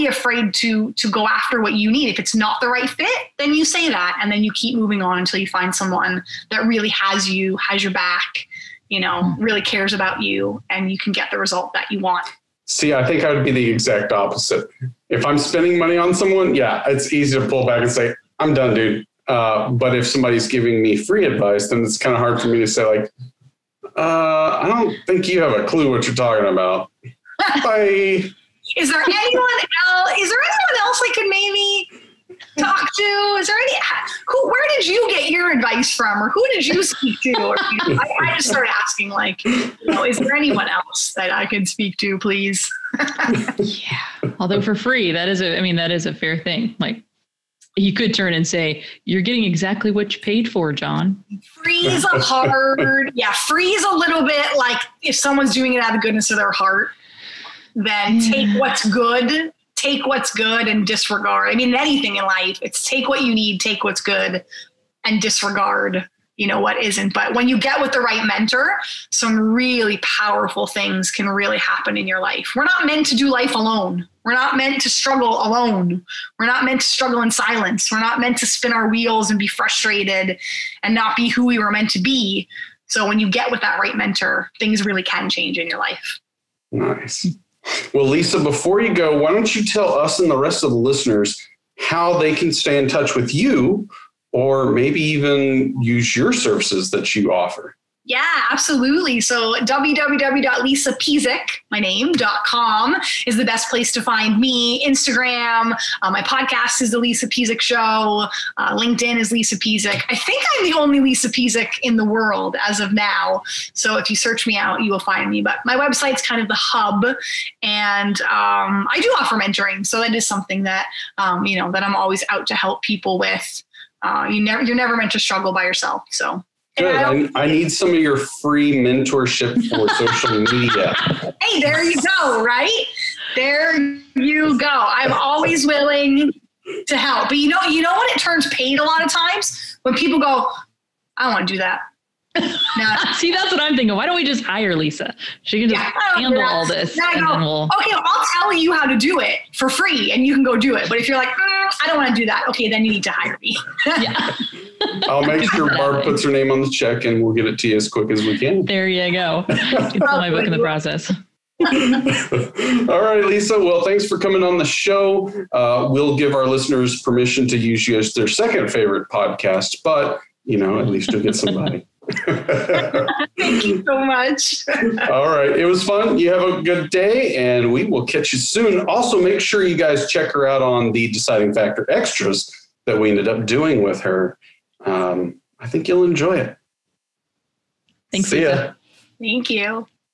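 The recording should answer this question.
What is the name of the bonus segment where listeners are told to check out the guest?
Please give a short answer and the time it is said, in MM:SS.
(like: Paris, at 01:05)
Deciding Factor extras, at 03:01.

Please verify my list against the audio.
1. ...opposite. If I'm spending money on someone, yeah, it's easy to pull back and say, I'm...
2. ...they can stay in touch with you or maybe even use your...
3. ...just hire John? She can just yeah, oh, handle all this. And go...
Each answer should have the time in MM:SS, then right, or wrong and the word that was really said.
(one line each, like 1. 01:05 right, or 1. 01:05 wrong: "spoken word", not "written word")
1. 00:14 right
2. 01:32 right
3. 02:24 wrong: "Lisa", not "John".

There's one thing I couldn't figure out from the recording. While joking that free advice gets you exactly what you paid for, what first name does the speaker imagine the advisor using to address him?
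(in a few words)
John.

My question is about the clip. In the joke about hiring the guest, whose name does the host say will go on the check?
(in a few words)
Barb.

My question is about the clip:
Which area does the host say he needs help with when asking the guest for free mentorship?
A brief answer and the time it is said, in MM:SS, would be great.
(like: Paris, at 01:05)
Social media, at 02:09.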